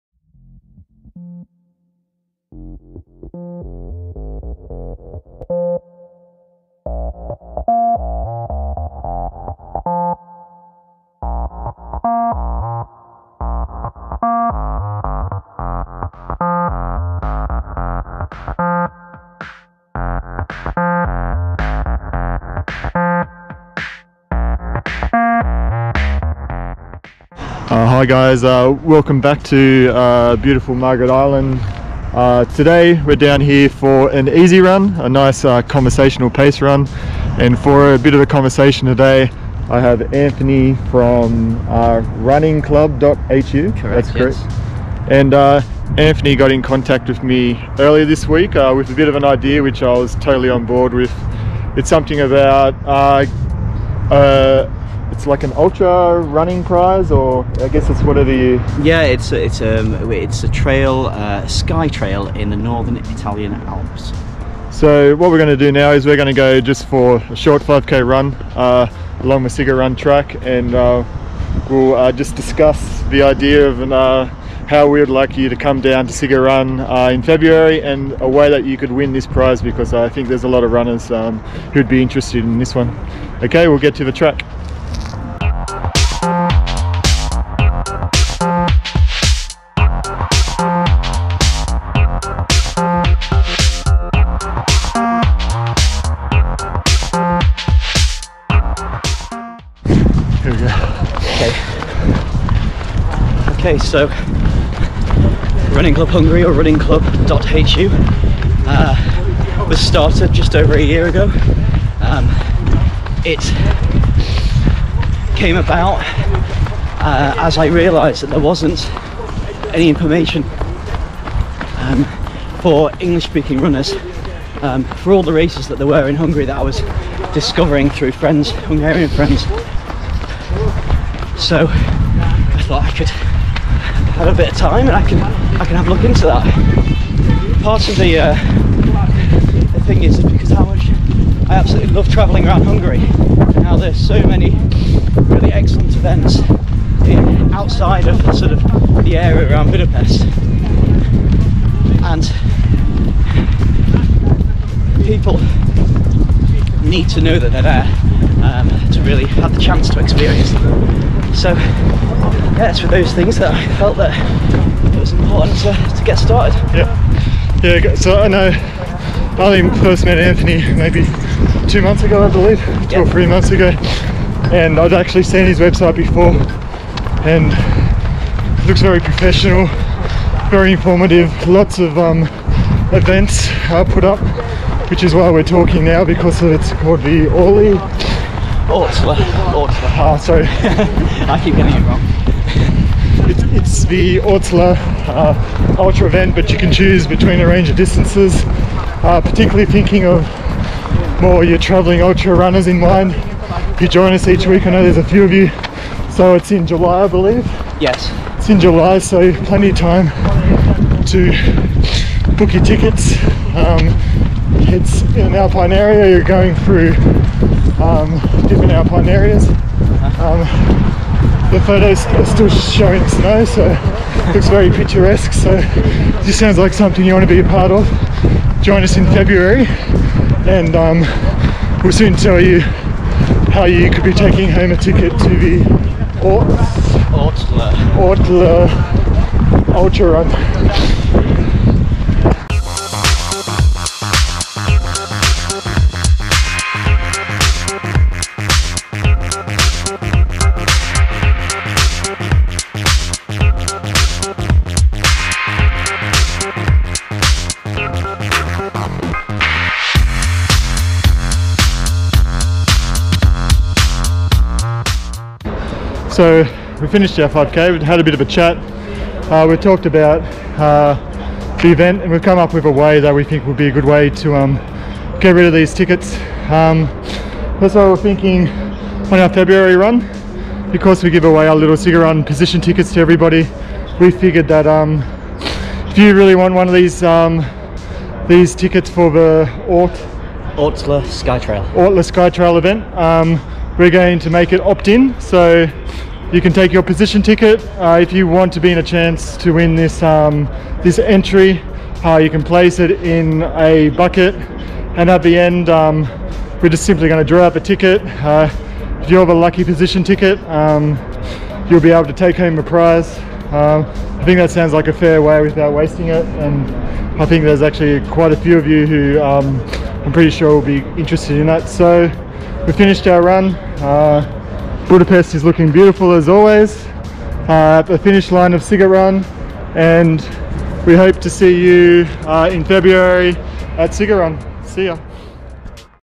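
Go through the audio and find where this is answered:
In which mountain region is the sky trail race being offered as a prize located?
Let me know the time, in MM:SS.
01:02.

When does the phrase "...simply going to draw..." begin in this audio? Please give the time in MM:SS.
05:06.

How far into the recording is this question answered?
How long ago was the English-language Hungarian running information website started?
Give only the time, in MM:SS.
01:50.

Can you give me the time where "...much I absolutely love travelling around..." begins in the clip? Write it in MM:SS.
02:20.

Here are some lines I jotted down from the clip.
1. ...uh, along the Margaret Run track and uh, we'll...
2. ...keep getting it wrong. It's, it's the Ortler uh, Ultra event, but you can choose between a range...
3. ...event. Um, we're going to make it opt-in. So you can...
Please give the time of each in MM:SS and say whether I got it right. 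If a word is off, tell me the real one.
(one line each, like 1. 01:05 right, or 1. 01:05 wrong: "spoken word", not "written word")
1. 01:08 wrong: "Sziget", not "Margaret"
2. 03:11 right
3. 04:52 right.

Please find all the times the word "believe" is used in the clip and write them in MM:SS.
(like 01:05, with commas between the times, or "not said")
02:52, 03:27.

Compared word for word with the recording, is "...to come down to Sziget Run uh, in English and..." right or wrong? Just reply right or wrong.
wrong.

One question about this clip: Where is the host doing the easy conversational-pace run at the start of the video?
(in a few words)
Margaret Island.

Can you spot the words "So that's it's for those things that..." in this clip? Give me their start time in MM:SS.
02:41.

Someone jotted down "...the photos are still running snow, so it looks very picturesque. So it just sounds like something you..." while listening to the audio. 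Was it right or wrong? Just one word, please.
wrong.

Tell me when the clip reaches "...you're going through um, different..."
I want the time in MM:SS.
03:36.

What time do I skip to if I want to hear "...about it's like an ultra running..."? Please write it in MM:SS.
00:52.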